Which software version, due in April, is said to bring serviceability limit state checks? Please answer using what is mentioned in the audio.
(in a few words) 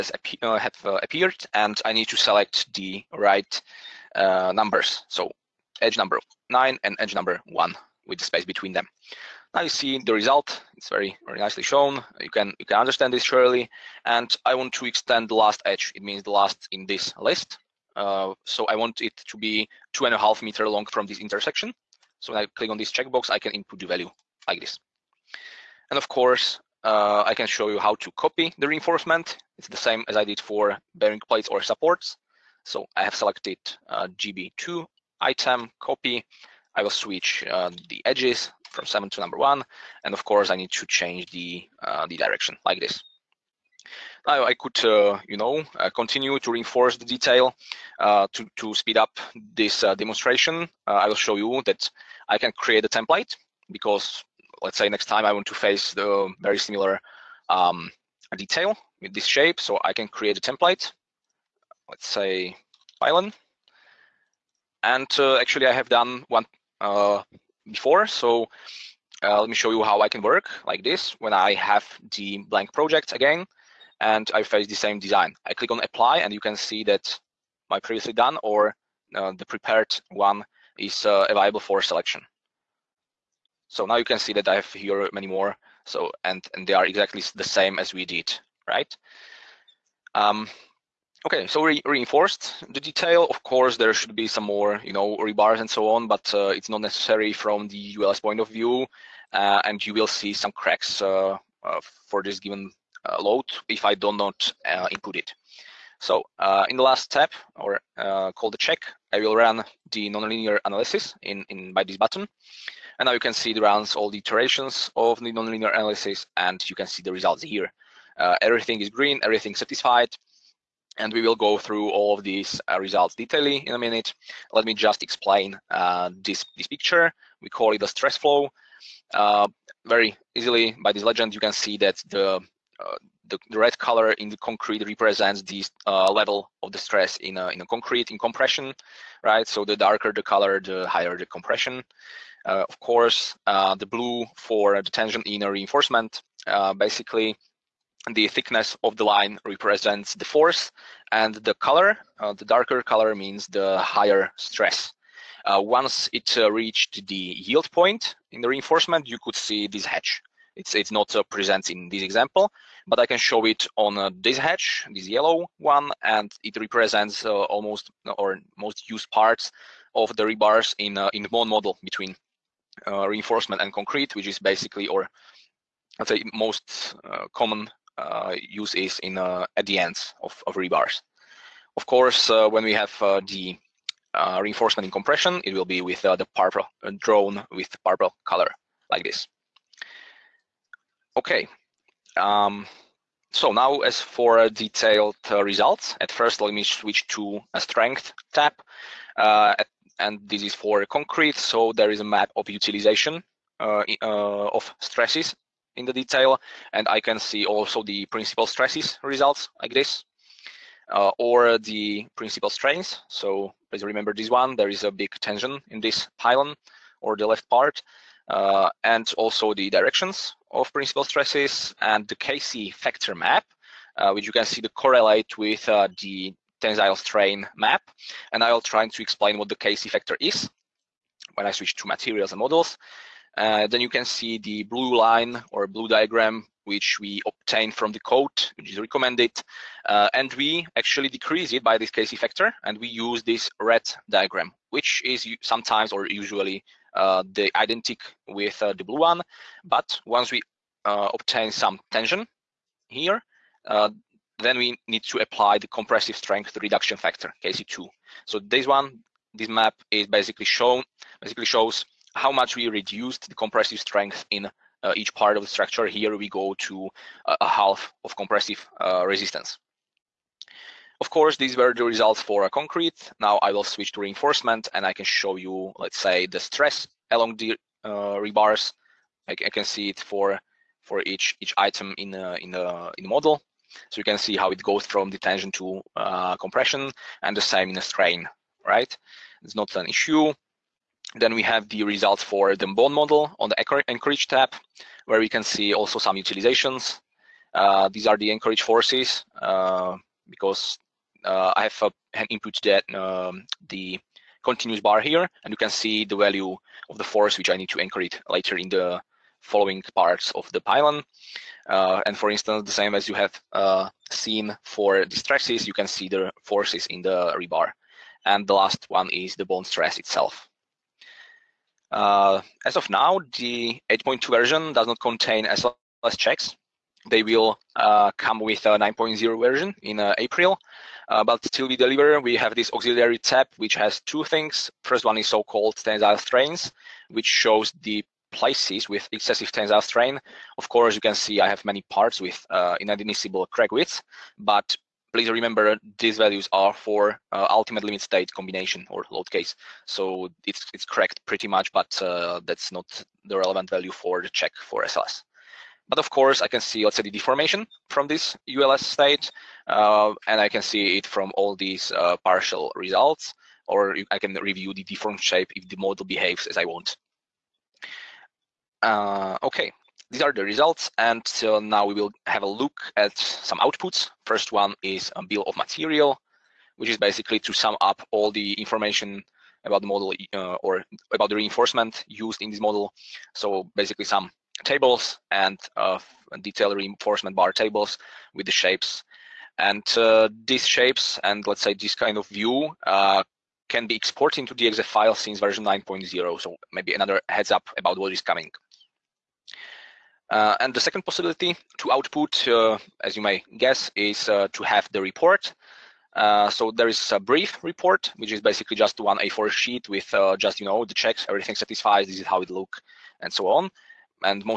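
9.0.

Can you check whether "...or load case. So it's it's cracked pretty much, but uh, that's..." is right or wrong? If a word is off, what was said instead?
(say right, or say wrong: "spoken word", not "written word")
right.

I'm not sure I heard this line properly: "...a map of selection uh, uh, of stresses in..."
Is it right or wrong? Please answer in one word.
wrong.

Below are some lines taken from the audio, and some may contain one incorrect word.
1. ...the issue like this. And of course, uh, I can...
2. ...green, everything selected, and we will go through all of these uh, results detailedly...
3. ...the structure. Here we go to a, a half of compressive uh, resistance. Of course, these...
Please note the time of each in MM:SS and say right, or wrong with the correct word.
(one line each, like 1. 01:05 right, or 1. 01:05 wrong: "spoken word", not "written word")
1. 00:23 wrong: "value", not "issue"
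2. 01:58 wrong: "satisfied", not "selected"
3. 04:25 right.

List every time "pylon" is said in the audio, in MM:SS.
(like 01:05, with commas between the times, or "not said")
01:02, 03:36, 05:10.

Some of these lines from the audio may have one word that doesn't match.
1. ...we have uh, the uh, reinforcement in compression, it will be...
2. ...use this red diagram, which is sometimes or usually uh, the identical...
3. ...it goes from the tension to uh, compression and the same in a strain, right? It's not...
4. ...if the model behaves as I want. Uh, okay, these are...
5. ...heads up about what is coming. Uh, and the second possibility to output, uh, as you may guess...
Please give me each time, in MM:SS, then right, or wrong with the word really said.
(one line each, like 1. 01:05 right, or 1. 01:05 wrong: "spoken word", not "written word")
1. 03:02 right
2. 04:02 right
3. 04:44 right
4. 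06:05 right
5. 06:37 right.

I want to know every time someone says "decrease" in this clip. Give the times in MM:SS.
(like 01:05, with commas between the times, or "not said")
04:01.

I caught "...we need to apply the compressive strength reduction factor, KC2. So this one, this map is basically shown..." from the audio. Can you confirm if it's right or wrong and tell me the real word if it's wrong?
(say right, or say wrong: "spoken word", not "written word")
right.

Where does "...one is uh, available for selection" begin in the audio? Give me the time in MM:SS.
01:20.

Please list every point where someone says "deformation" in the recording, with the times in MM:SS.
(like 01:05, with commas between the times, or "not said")
05:57.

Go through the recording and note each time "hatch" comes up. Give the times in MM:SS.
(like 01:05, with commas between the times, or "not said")
02:39, 02:44.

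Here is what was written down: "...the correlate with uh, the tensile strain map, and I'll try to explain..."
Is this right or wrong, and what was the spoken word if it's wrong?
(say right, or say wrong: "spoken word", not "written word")
right.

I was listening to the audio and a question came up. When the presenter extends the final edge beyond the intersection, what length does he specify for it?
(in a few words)
2.5 meters.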